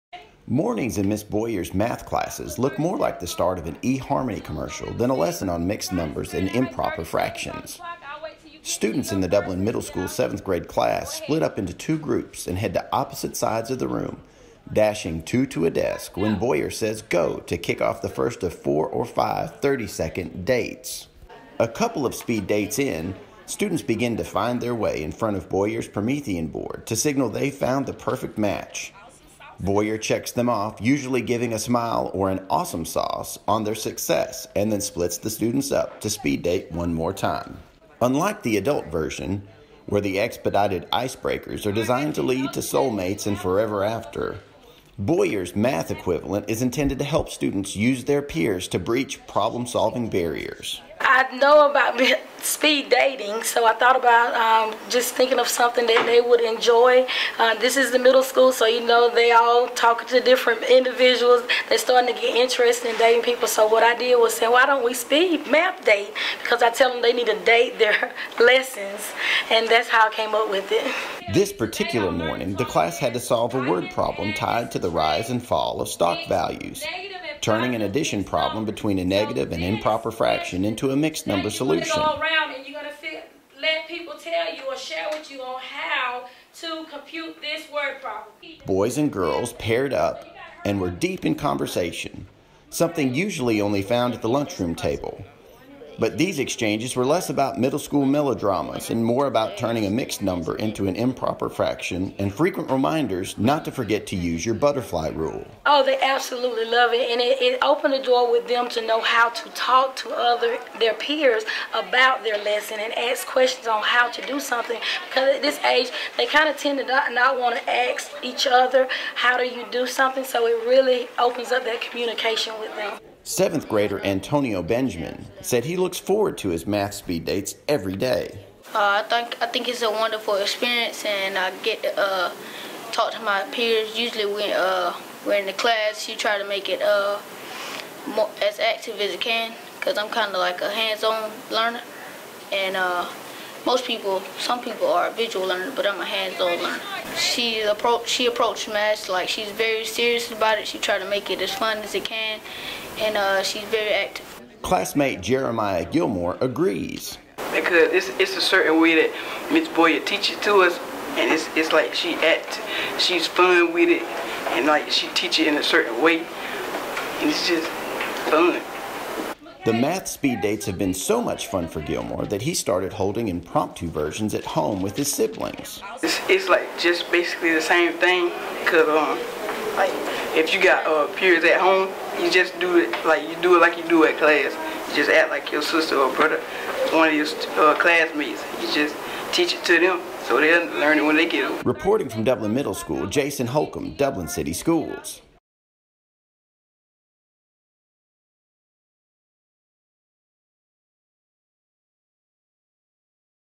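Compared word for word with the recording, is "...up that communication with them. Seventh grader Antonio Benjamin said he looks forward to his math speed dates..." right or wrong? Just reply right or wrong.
right.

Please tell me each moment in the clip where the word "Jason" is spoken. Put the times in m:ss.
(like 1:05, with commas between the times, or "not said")
3:13.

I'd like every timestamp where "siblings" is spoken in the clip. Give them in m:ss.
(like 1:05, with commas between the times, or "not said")
2:55.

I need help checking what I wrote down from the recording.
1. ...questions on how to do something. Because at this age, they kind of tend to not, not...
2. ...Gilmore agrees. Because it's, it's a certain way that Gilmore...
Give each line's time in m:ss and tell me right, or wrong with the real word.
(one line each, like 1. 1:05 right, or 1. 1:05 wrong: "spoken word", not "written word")
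1. 1:53 right
2. 2:35 wrong: "Miss", not "Gilmore".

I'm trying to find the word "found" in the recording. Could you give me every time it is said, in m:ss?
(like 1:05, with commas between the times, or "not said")
0:27, 1:33.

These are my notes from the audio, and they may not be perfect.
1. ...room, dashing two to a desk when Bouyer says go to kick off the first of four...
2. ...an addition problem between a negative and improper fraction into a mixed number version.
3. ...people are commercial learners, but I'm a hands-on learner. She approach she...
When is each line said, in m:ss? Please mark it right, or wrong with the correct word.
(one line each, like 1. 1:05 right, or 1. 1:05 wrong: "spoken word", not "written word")
1. 0:13 right
2. 1:17 wrong: "solution", not "version"
3. 2:24 wrong: "visual", not "commercial".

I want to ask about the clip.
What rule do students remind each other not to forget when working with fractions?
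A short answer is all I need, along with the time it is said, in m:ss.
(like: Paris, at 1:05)
butterfly rule, at 1:44.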